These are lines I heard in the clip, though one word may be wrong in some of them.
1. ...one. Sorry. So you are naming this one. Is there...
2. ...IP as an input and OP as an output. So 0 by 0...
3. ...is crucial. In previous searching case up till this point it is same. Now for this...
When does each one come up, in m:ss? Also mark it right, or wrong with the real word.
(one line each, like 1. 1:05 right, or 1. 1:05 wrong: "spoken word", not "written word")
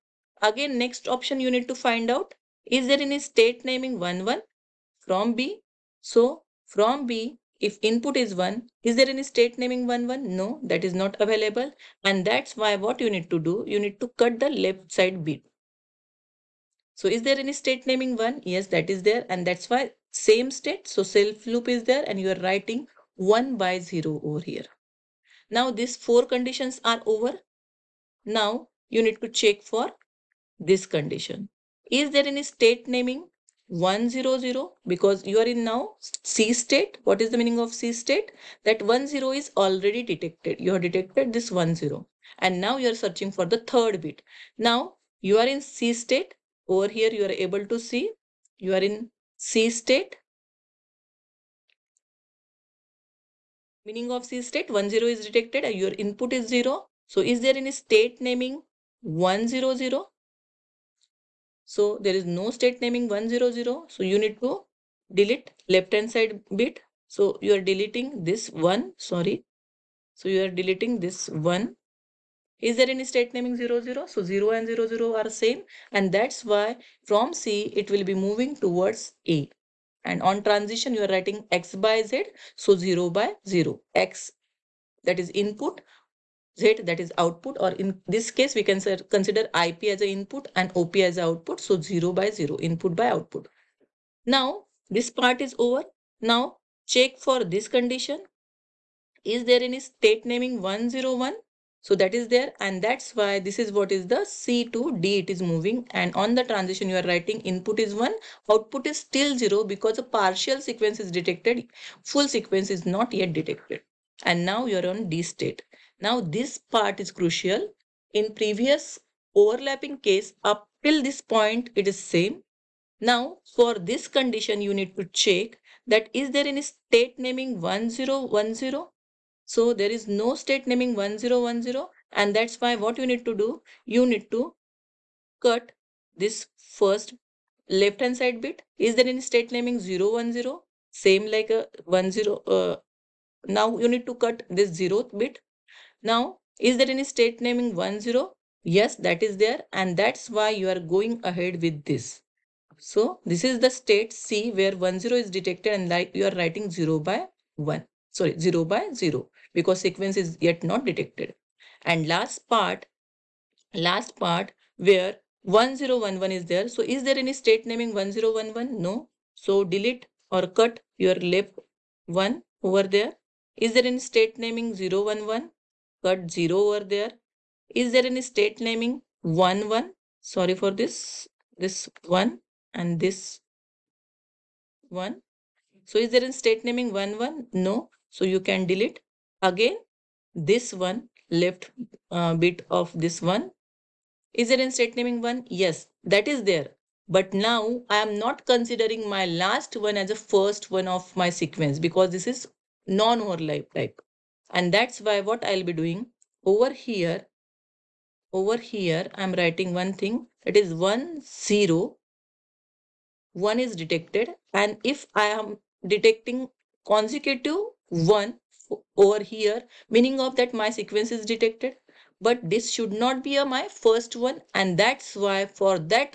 1. 1:08 wrong: "deleting", not "naming"
2. 1:29 right
3. 1:56 wrong: "overlapping", not "searching".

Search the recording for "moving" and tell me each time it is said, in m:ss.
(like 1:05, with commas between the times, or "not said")
1:18, 1:45.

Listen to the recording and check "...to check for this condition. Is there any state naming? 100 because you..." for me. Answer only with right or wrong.
right.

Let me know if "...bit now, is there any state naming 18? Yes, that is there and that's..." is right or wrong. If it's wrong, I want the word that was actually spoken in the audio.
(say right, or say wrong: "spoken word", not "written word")
wrong: "10", not "18".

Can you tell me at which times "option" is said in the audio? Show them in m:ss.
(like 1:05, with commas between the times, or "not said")
0:01.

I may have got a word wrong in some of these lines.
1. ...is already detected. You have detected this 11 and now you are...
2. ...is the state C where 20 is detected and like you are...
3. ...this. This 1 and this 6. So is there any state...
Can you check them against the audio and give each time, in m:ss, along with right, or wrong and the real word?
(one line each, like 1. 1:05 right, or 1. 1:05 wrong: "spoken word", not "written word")
1. 0:39 wrong: "10", not "11"
2. 2:33 wrong: "10", not "20"
3. 3:00 wrong: "1", not "6".